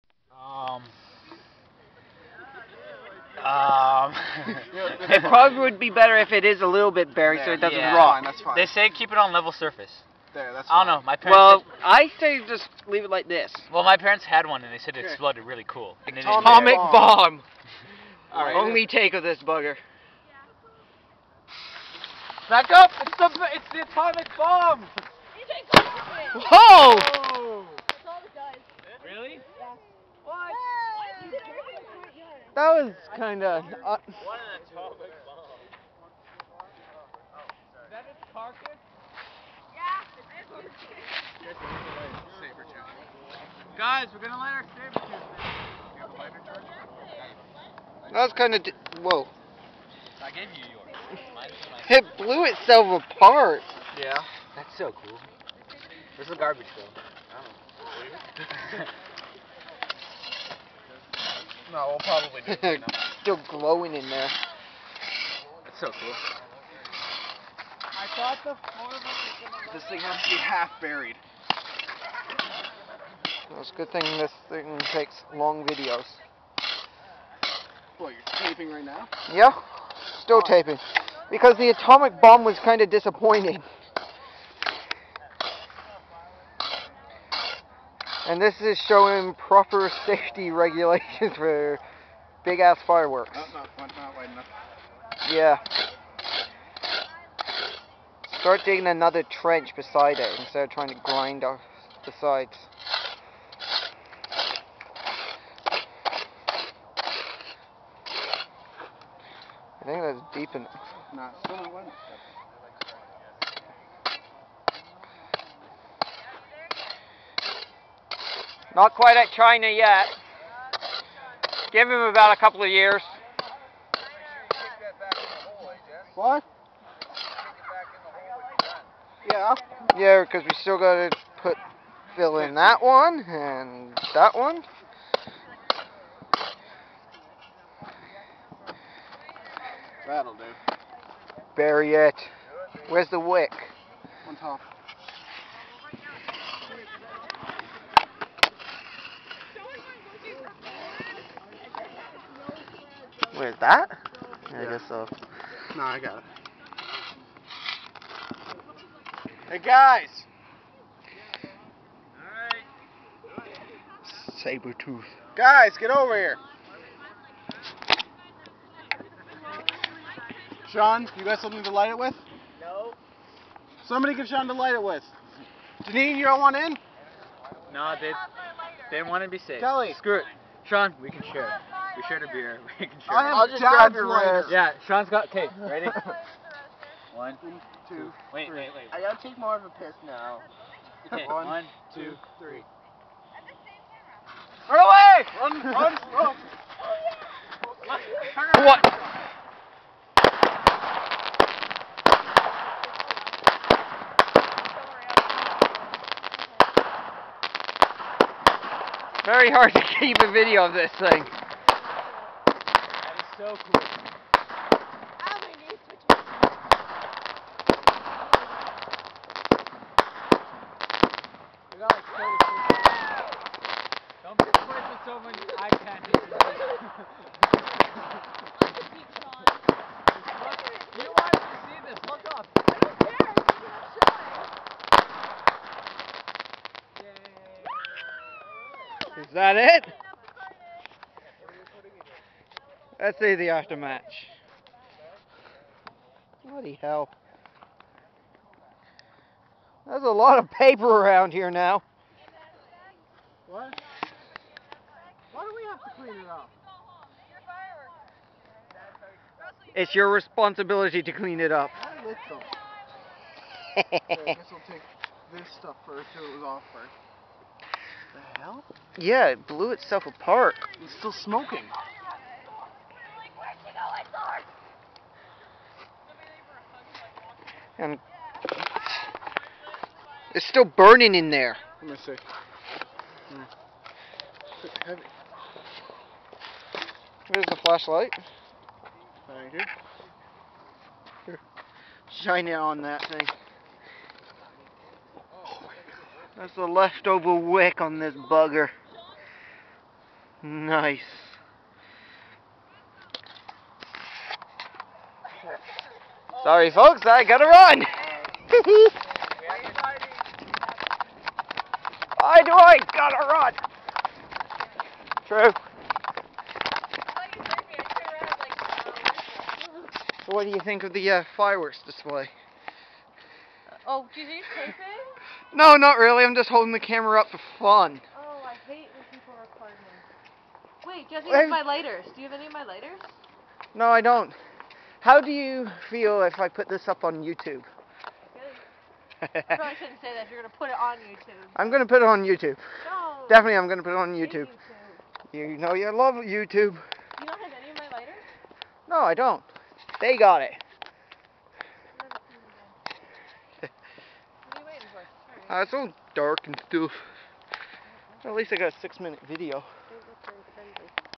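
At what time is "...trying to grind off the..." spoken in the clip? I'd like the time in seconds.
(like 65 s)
100 s.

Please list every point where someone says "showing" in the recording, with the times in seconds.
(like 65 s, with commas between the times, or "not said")
88 s, 236 s.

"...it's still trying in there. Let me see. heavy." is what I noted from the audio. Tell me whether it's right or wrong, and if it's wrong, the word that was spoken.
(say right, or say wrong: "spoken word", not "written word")
wrong: "burning", not "trying".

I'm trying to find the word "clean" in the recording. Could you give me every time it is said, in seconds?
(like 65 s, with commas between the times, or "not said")
256 s, 261 s.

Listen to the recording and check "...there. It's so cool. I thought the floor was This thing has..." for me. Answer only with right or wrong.
right.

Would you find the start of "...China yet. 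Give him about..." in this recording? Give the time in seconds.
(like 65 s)
119 s.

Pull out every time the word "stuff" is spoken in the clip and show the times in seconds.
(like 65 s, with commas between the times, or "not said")
265 s, 356 s.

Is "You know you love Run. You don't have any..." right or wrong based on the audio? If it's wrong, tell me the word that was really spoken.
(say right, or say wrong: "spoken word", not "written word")
wrong: "YouTube", not "Run".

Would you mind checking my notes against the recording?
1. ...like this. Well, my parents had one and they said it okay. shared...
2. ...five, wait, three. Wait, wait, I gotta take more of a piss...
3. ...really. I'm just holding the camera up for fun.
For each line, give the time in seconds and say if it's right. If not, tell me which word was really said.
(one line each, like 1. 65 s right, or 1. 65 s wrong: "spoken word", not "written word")
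1. 13 s wrong: "exploded", not "shared"
2. 187 s wrong: "two", not "five"
3. 325 s right.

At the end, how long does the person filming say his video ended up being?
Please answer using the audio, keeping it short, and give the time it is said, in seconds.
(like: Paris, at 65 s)
6 minutes, at 358 s.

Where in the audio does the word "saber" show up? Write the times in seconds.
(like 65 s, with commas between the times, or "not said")
44 s, 164 s.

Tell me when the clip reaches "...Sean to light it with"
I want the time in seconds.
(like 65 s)
174 s.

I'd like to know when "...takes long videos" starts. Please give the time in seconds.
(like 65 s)
74 s.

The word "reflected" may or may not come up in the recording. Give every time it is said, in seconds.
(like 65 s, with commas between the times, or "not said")
not said.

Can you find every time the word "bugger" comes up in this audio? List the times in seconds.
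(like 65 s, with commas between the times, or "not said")
19 s, 298 s.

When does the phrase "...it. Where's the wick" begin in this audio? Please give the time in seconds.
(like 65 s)
141 s.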